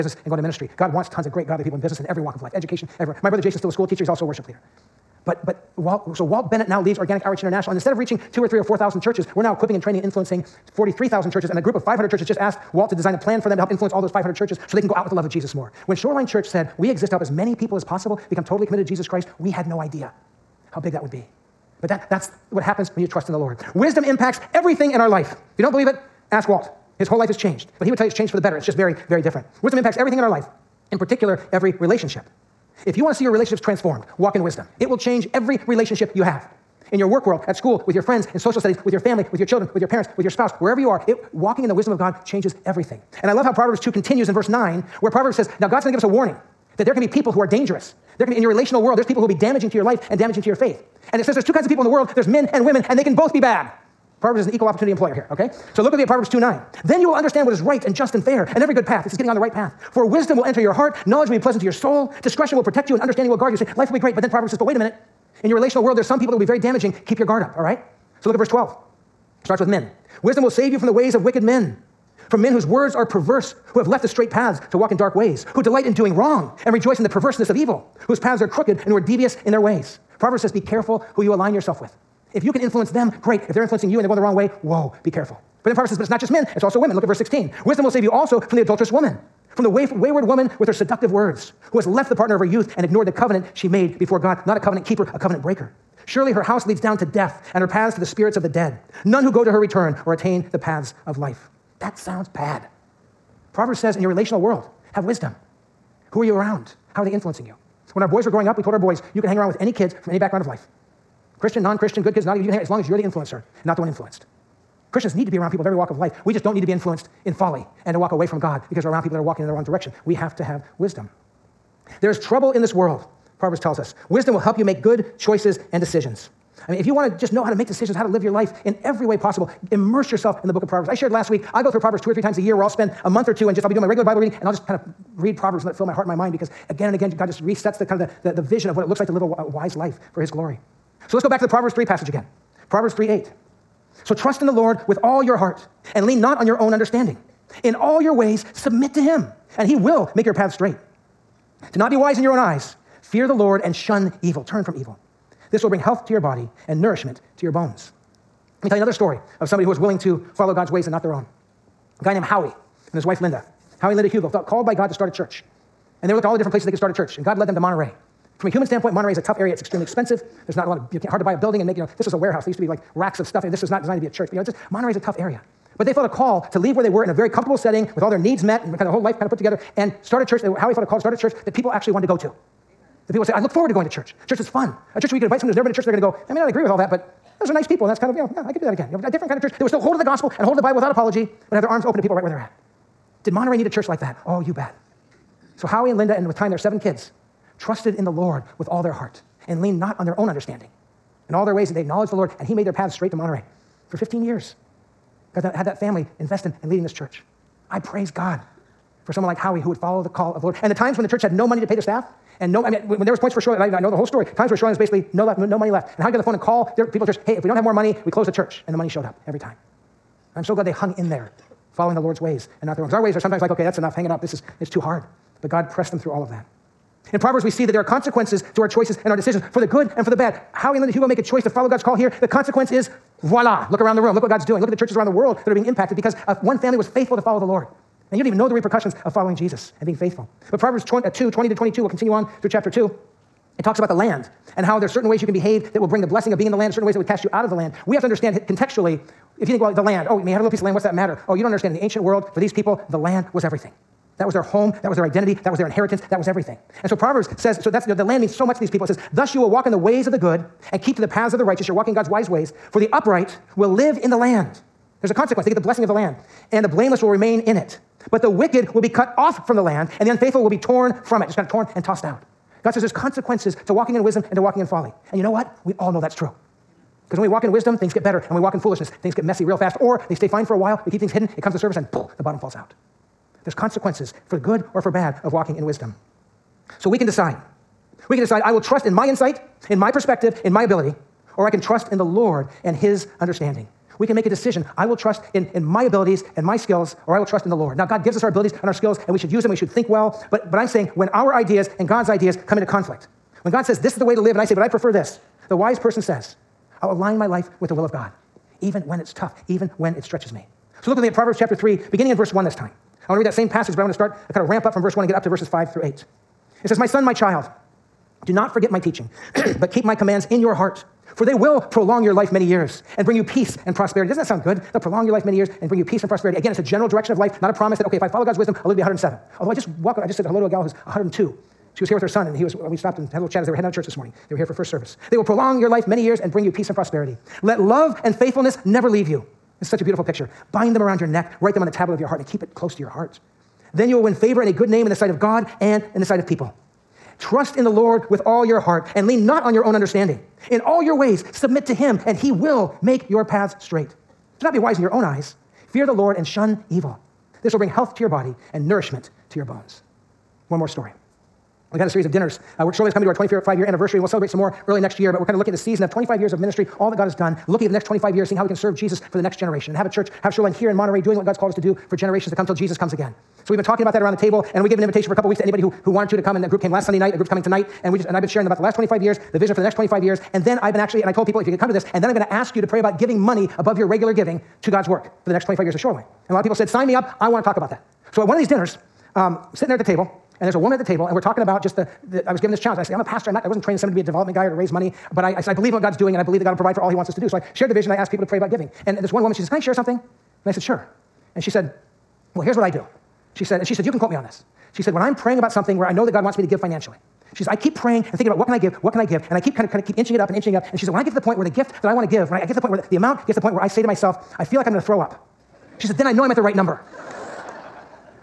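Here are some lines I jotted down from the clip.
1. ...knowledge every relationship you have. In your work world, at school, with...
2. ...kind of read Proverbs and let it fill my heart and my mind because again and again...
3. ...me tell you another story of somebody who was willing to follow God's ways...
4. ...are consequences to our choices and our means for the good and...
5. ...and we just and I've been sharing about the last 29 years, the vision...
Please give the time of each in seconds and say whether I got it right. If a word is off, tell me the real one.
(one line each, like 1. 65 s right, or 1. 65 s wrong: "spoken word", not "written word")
1. 34 s wrong: "change", not "knowledge"
2. 134 s right
3. 158 s right
4. 227 s wrong: "decisions", not "means"
5. 377 s wrong: "25", not "29".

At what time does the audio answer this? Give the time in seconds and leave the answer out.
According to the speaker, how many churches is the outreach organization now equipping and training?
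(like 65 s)
10 s.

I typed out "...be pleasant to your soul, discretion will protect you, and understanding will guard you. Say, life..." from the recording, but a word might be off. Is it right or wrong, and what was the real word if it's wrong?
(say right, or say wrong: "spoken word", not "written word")
right.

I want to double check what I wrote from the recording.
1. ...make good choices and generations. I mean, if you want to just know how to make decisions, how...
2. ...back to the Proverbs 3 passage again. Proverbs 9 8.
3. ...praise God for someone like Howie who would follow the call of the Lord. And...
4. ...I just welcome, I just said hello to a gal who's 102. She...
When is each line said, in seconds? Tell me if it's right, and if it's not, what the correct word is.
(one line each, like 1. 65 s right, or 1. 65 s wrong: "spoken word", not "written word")
1. 124 s wrong: "decisions", not "generations"
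2. 141 s wrong: "3", not "9"
3. 207 s right
4. 329 s right.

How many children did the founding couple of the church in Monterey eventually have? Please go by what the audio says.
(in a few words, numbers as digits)
7.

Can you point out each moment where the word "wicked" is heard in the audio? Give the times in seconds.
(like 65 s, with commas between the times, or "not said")
71 s, 268 s.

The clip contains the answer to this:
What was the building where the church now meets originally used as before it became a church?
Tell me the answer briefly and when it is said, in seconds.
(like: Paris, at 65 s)
a warehouse, at 172 s.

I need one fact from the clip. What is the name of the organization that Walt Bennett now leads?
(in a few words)
Organic Outreach International.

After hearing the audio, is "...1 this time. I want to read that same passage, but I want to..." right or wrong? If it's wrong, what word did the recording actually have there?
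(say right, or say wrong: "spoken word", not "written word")
right.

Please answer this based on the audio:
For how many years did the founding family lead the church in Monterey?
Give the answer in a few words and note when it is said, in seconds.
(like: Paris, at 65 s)
15, at 203 s.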